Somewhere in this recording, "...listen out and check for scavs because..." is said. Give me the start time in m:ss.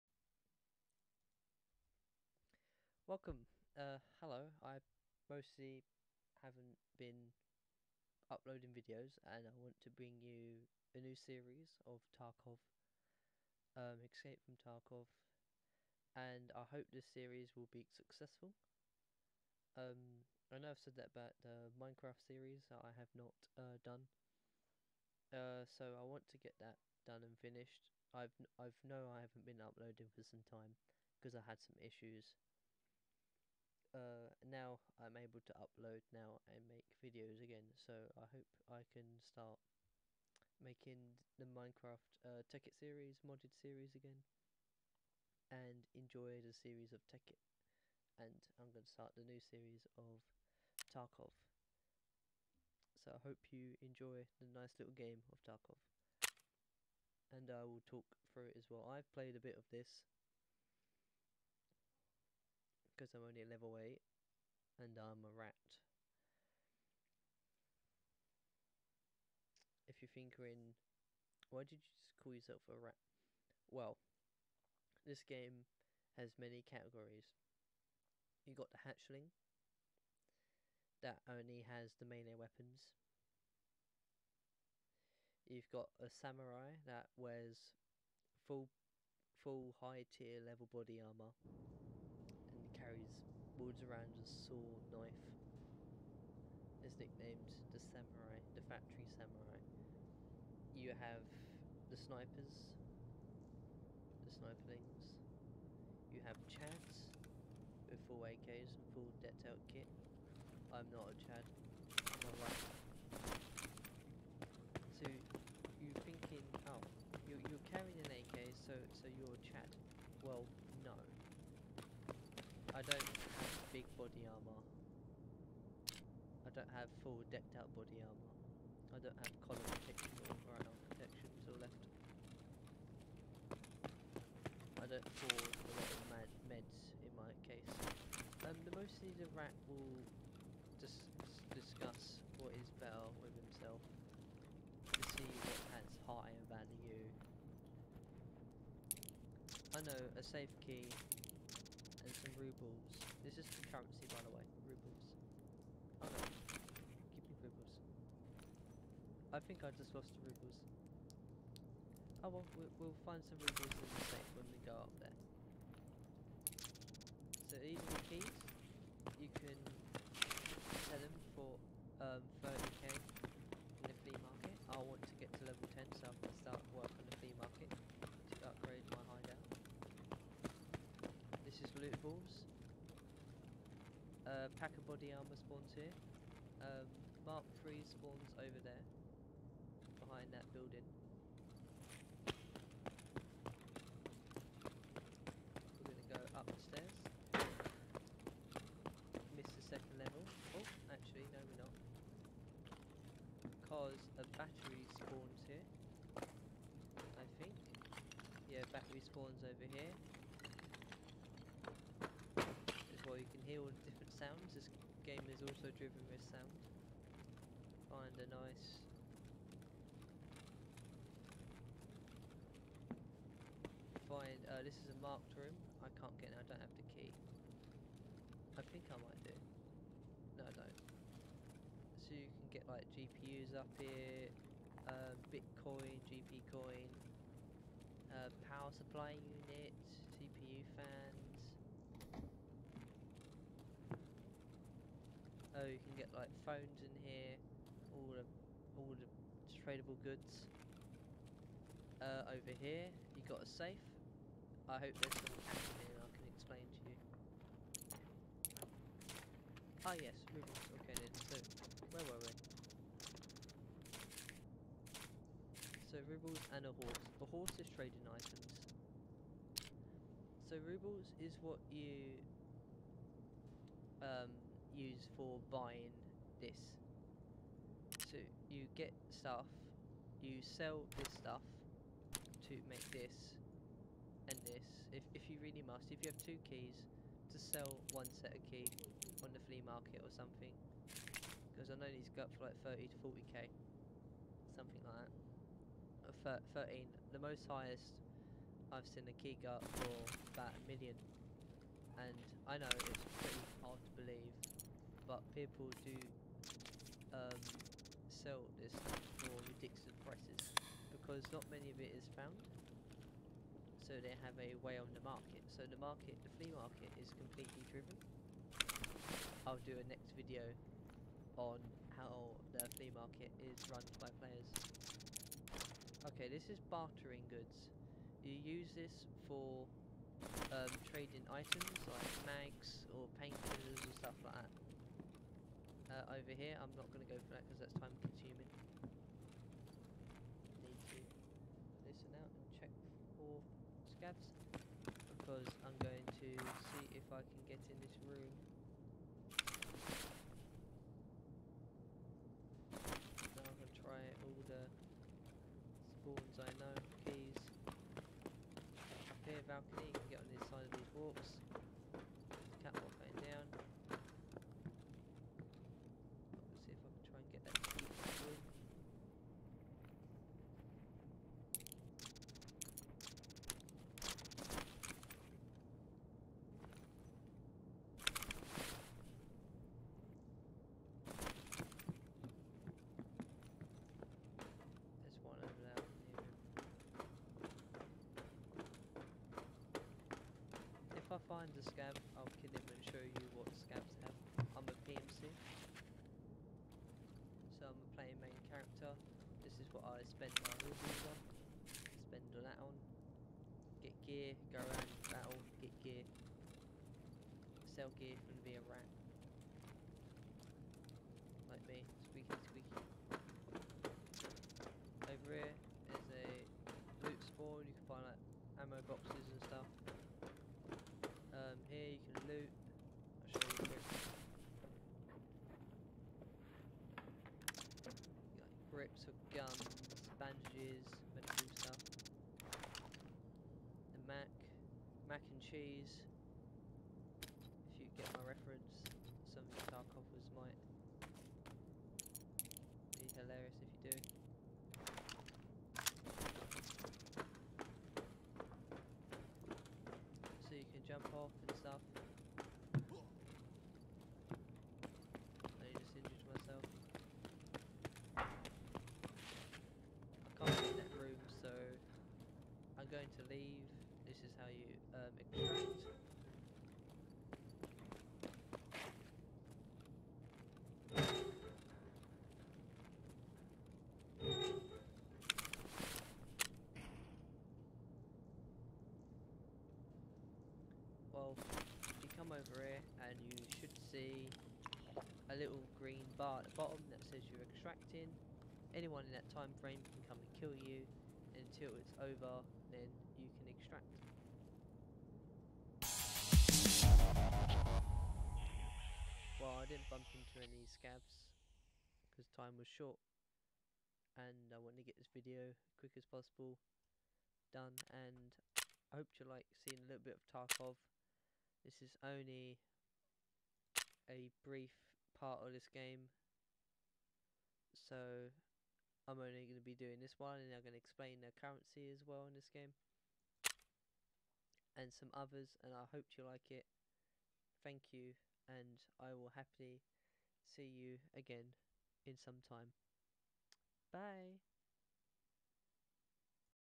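5:41.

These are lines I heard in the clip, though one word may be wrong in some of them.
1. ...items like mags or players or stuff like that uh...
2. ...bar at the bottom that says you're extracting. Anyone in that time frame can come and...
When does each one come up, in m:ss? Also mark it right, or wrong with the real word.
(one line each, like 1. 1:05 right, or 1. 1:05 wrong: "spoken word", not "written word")
1. 5:31 wrong: "painters", not "players"
2. 8:06 right.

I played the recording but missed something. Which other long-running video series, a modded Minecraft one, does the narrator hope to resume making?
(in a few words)
Tekkit.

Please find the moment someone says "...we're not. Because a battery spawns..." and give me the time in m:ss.
3:21.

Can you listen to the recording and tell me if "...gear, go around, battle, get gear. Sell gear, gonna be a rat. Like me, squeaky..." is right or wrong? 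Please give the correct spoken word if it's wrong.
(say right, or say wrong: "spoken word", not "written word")
right.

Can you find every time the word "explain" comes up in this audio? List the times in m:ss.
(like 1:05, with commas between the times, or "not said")
4:16, 8:40.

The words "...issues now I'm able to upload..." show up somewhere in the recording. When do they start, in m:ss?
0:31.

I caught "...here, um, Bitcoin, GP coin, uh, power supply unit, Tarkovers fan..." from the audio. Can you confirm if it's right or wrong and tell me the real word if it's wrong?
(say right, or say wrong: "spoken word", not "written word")
wrong: "CPU", not "Tarkovers".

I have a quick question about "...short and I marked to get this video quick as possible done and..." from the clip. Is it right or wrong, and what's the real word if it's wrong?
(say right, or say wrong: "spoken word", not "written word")
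wrong: "wanted", not "marked".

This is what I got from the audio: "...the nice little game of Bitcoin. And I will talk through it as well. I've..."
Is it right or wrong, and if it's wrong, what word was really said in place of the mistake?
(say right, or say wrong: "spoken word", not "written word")
wrong: "Tarkov", not "Bitcoin".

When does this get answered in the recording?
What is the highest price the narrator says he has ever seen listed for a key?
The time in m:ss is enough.
5:00.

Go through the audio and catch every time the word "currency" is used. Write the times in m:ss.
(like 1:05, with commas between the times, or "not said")
2:33, 8:41.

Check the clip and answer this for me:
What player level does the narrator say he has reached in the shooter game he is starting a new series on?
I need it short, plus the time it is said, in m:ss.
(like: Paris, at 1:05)
8, at 1:03.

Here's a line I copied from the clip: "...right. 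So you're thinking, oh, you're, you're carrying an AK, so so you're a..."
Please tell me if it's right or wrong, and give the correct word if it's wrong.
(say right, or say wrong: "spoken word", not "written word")
right.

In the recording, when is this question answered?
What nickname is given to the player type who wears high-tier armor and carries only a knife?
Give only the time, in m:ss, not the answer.
1:38.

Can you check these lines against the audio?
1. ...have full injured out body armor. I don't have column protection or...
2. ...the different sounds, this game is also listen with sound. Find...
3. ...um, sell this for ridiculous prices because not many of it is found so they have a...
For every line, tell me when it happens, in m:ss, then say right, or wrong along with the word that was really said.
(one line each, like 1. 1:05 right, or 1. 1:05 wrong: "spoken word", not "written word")
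1. 2:06 wrong: "decked", not "injured"
2. 3:33 wrong: "driven", not "listen"
3. 5:07 right.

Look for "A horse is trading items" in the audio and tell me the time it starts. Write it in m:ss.
4:27.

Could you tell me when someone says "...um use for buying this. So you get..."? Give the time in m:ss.
4:34.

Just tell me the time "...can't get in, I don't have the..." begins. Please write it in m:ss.
3:45.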